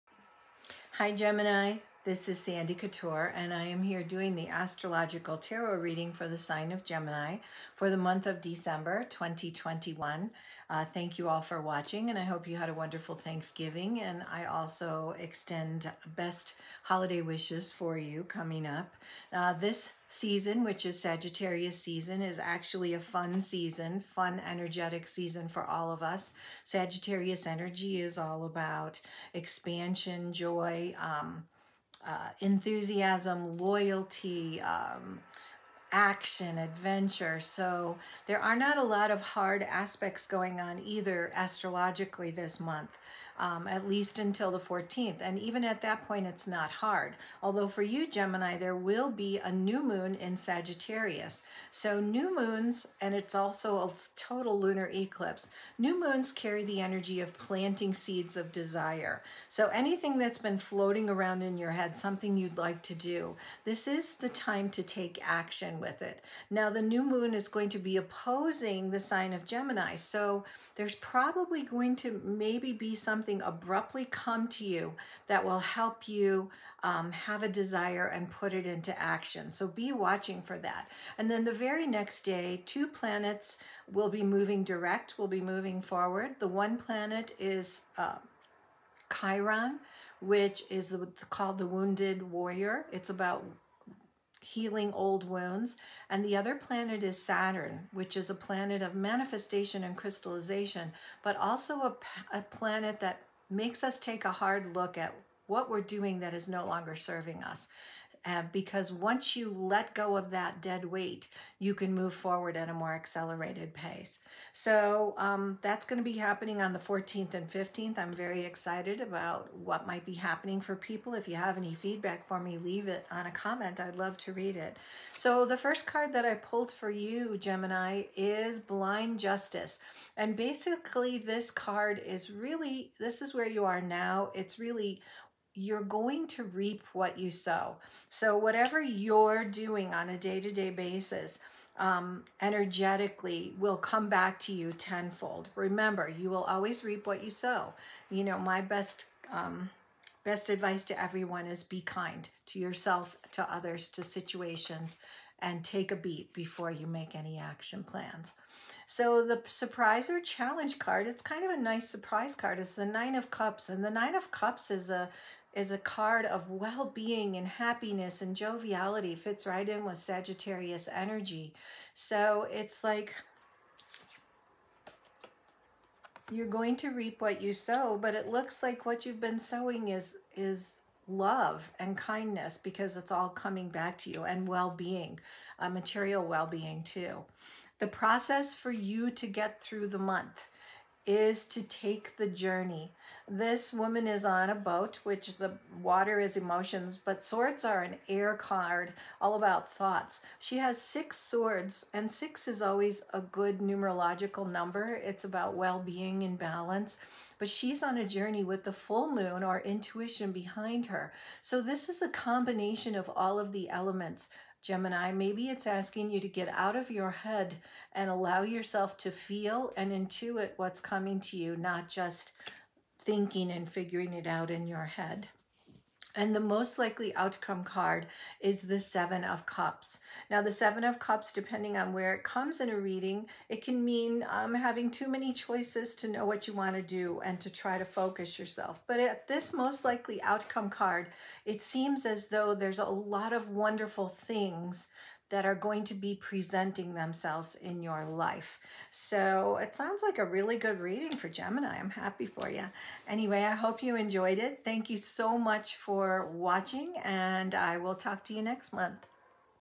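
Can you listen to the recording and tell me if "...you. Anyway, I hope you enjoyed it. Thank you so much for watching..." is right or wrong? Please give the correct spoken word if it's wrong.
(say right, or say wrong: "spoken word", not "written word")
right.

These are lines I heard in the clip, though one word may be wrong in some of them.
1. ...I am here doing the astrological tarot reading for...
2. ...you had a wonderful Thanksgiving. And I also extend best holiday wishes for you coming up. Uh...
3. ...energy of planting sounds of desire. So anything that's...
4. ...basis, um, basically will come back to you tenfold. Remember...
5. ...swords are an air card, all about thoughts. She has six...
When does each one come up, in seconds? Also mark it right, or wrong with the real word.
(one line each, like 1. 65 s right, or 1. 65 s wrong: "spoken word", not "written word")
1. 3 s right
2. 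12 s right
3. 56 s wrong: "seeds", not "sounds"
4. 140 s wrong: "energetically", not "basically"
5. 197 s right.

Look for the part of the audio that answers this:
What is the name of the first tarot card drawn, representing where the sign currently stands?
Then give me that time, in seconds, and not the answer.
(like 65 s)
128 s.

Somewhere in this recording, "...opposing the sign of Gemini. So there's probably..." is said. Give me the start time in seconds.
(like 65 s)
67 s.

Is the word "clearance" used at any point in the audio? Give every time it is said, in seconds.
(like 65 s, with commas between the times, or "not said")
not said.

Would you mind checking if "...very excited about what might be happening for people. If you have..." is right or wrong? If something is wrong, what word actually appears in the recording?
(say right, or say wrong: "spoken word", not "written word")
right.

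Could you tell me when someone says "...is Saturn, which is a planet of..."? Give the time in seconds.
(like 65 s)
97 s.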